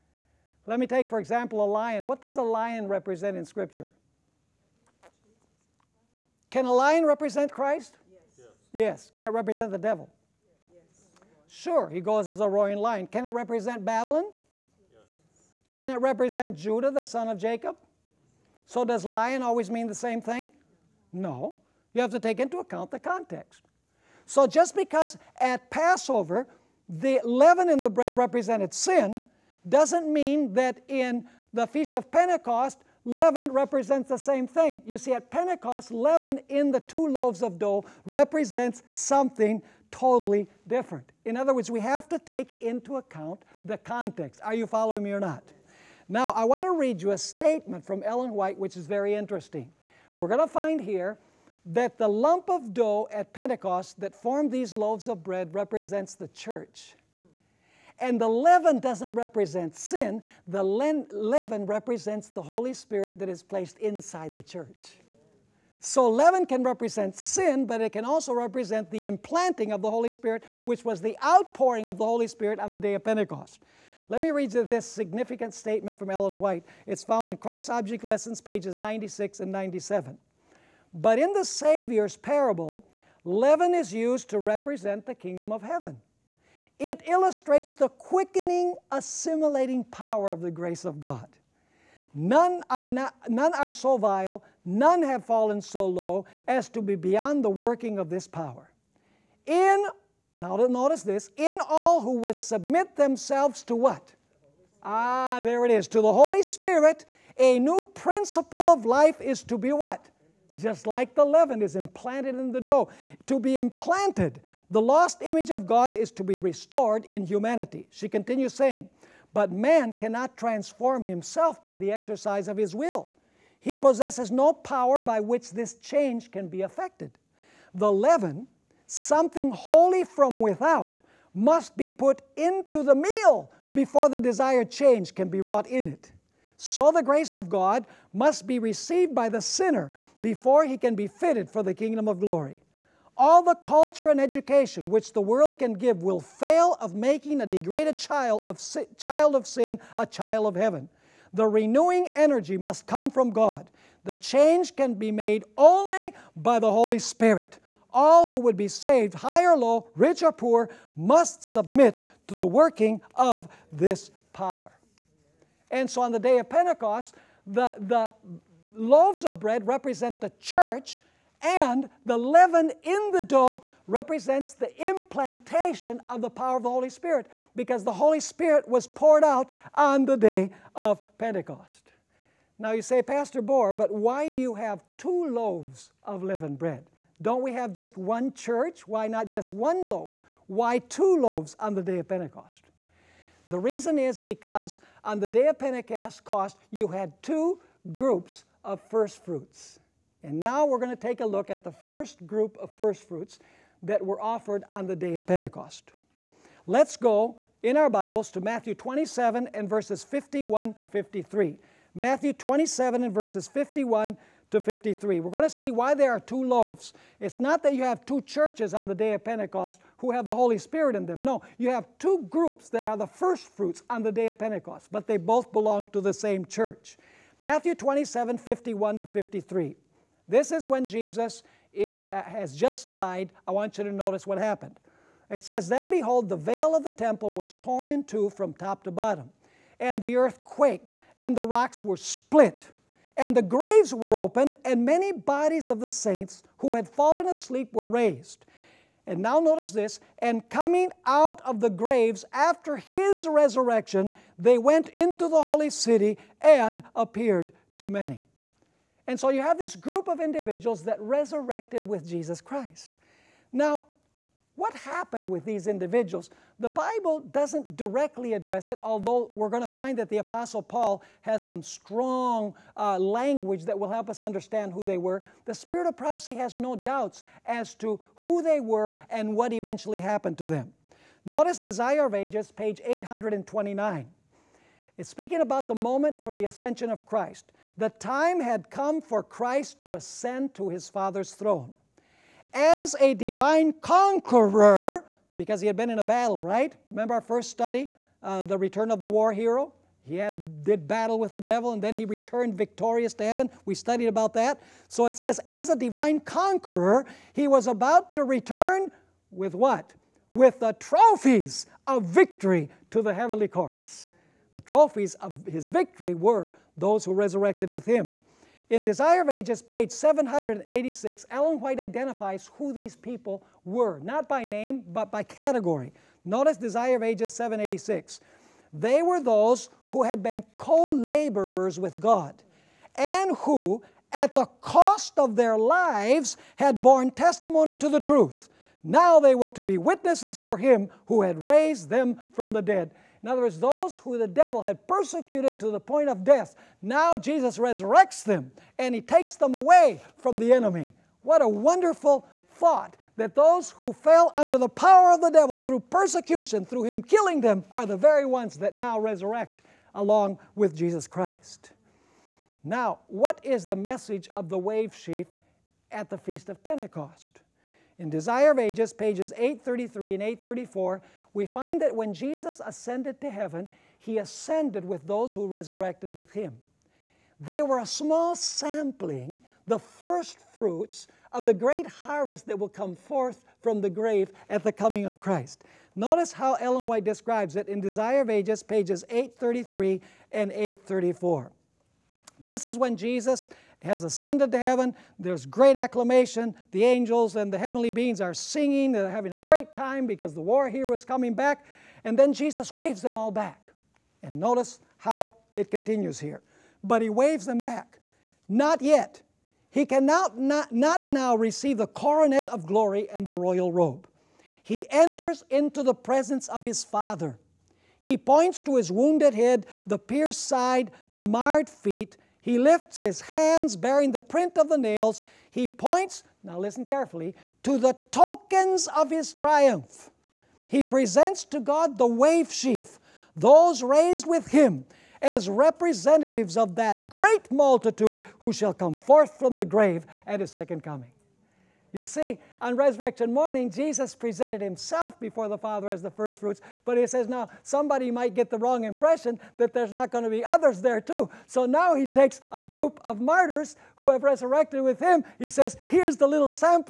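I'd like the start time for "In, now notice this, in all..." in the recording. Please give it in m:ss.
1:39.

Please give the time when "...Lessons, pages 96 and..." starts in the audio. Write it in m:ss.
1:18.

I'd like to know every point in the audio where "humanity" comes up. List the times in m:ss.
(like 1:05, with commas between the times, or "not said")
1:57.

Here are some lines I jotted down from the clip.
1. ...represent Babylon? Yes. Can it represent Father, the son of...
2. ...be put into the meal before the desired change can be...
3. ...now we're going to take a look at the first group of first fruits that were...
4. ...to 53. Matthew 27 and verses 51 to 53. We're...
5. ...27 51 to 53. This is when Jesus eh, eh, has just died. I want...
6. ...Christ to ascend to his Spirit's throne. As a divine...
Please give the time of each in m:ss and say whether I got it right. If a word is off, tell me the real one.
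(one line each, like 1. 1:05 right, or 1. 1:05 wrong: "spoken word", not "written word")
1. 0:13 wrong: "Judah", not "Father"
2. 2:11 right
3. 3:20 right
4. 3:30 right
5. 3:47 right
6. 4:49 wrong: "Father", not "Spirit".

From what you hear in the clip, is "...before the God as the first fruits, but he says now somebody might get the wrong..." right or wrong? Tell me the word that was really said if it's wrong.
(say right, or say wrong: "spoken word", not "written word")
wrong: "Father", not "God".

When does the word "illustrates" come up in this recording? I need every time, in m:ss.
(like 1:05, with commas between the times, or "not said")
1:27.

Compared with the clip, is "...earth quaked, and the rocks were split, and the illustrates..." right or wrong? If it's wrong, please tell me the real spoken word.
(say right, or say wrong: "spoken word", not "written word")
wrong: "graves", not "illustrates".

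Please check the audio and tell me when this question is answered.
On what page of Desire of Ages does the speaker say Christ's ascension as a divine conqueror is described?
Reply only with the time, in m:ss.
4:42.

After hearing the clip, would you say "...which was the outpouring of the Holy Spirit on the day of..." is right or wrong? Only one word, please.
right.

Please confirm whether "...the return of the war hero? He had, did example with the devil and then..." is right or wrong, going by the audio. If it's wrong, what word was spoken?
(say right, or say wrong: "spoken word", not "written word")
wrong: "battle", not "example".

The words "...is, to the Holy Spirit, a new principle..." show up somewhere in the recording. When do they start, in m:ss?
1:45.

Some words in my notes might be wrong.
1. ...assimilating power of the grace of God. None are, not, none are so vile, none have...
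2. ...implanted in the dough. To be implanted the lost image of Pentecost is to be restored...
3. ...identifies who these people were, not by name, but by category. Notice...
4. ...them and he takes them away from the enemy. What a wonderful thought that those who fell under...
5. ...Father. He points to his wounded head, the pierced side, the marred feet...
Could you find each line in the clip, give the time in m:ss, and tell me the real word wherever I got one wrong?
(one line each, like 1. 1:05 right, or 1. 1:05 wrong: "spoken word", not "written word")
1. 1:28 right
2. 1:51 wrong: "God", not "Pentecost"
3. 5:21 right
4. 5:48 right
5. 6:56 right.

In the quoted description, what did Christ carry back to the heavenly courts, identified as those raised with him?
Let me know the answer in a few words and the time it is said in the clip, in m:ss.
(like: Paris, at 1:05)
Trophies of victory, at 5:10.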